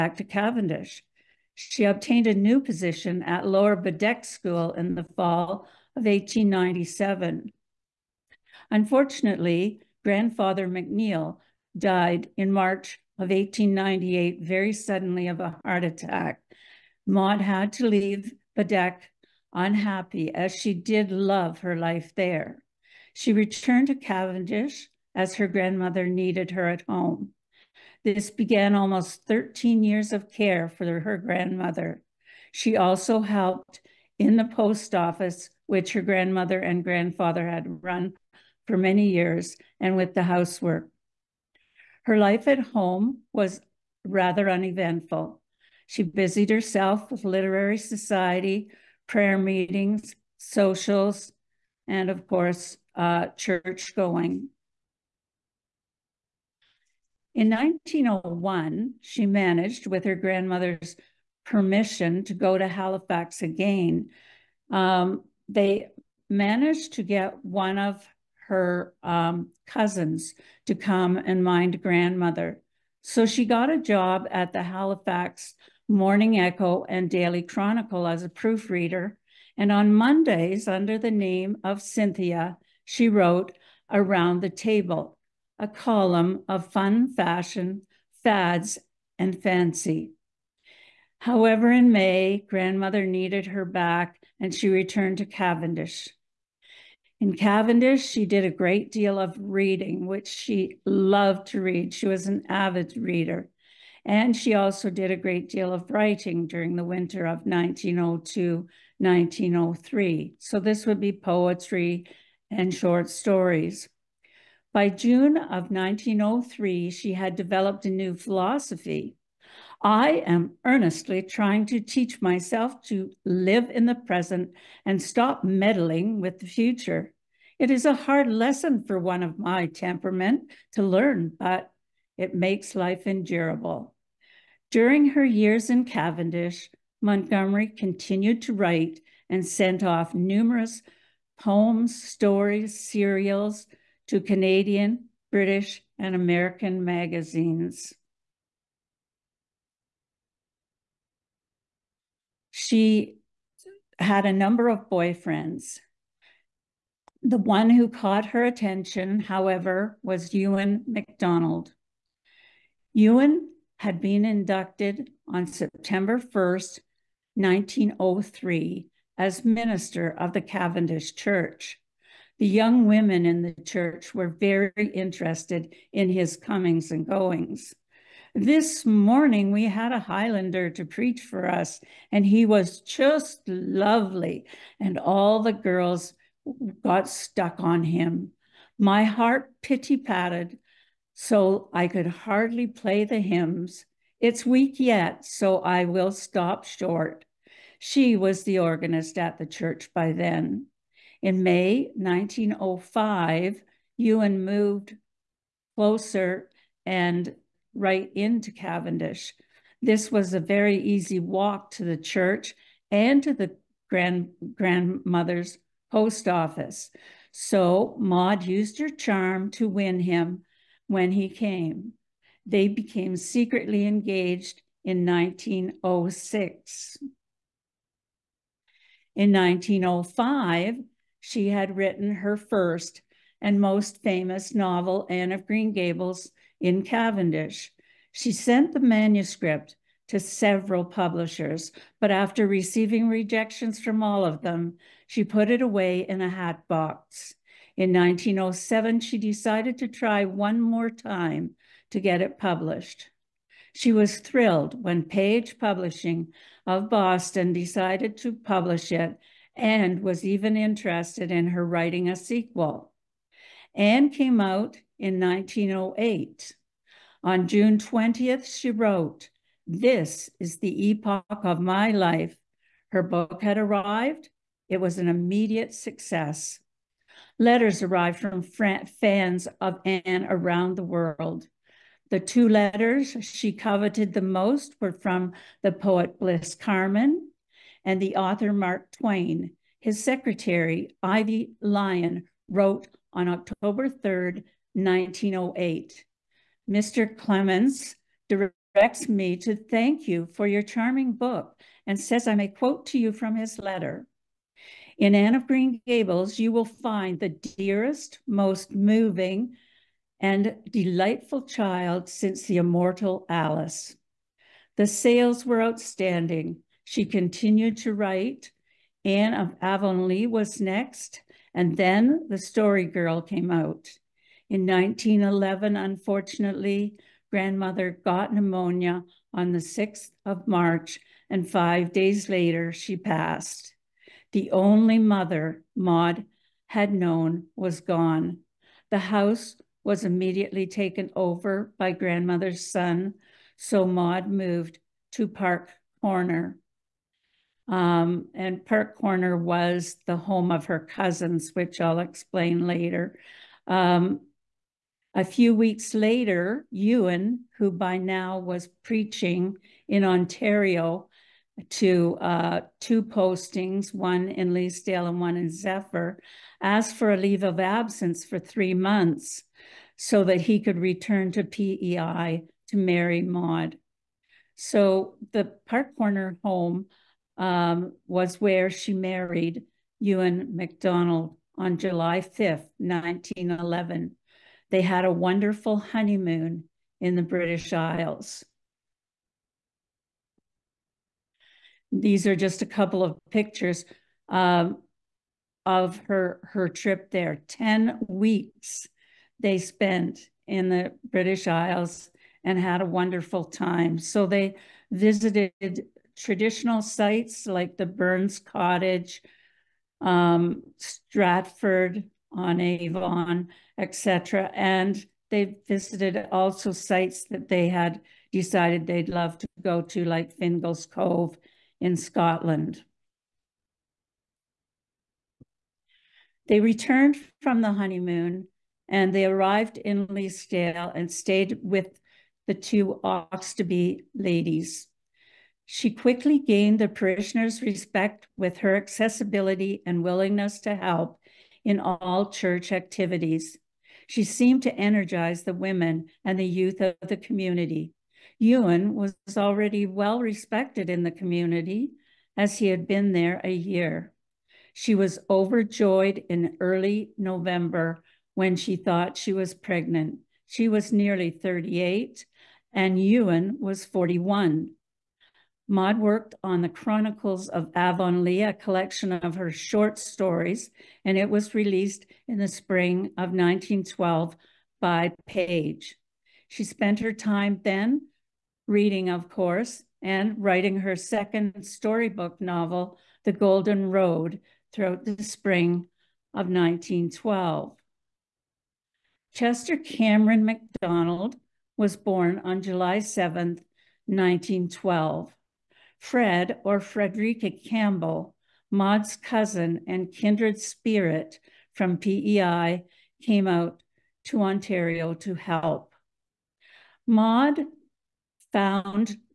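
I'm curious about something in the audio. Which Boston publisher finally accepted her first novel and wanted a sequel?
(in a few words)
Page Publishing.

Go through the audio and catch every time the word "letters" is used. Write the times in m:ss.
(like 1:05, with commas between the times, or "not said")
4:37, 4:42, 5:03.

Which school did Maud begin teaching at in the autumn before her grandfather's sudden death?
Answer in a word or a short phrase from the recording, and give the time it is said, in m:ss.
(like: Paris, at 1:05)
Lower Bedeque School, at 0:03.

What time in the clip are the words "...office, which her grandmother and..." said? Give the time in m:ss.
0:34.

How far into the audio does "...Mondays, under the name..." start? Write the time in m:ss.
1:19.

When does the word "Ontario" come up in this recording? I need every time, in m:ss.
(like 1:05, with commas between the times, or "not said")
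6:00, 8:24.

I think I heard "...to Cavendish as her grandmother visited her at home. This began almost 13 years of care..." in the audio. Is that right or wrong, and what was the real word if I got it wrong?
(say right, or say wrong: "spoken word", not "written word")
wrong: "needed", not "visited".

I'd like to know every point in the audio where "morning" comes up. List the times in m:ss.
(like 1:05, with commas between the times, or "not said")
1:15, 2:58.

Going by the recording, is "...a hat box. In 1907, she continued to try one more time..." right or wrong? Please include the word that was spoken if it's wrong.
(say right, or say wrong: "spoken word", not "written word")
wrong: "decided", not "continued".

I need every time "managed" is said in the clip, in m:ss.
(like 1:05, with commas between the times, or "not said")
0:59, 1:06.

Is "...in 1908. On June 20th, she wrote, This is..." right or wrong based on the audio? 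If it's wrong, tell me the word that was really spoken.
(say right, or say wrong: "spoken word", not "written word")
right.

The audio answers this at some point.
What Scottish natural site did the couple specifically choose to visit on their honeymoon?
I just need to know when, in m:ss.
7:00.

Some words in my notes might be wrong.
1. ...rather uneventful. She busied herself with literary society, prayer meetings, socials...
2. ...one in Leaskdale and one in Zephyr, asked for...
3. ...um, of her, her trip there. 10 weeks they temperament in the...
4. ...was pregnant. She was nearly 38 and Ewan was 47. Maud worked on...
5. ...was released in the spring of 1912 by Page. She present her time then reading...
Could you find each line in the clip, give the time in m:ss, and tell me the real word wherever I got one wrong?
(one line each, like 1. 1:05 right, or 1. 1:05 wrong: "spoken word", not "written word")
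1. 0:44 right
2. 6:03 right
3. 6:34 wrong: "spent", not "temperament"
4. 7:39 wrong: "41", not "47"
5. 7:51 wrong: "spent", not "present".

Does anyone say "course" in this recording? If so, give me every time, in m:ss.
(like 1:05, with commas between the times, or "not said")
0:52, 7:59.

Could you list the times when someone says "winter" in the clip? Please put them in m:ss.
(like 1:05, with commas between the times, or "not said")
1:46.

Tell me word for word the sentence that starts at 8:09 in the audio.
Chester Cameron MacDonald was born on July 7, 1912.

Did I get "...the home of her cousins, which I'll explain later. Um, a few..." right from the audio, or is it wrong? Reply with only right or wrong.
right.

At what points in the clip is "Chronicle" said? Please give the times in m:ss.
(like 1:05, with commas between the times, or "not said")
1:17, 7:46.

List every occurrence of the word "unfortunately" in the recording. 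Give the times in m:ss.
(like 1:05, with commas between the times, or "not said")
0:08, 5:25.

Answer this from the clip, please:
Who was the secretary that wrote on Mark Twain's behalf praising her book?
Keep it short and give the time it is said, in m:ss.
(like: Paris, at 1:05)
Ivy Lyon, at 4:51.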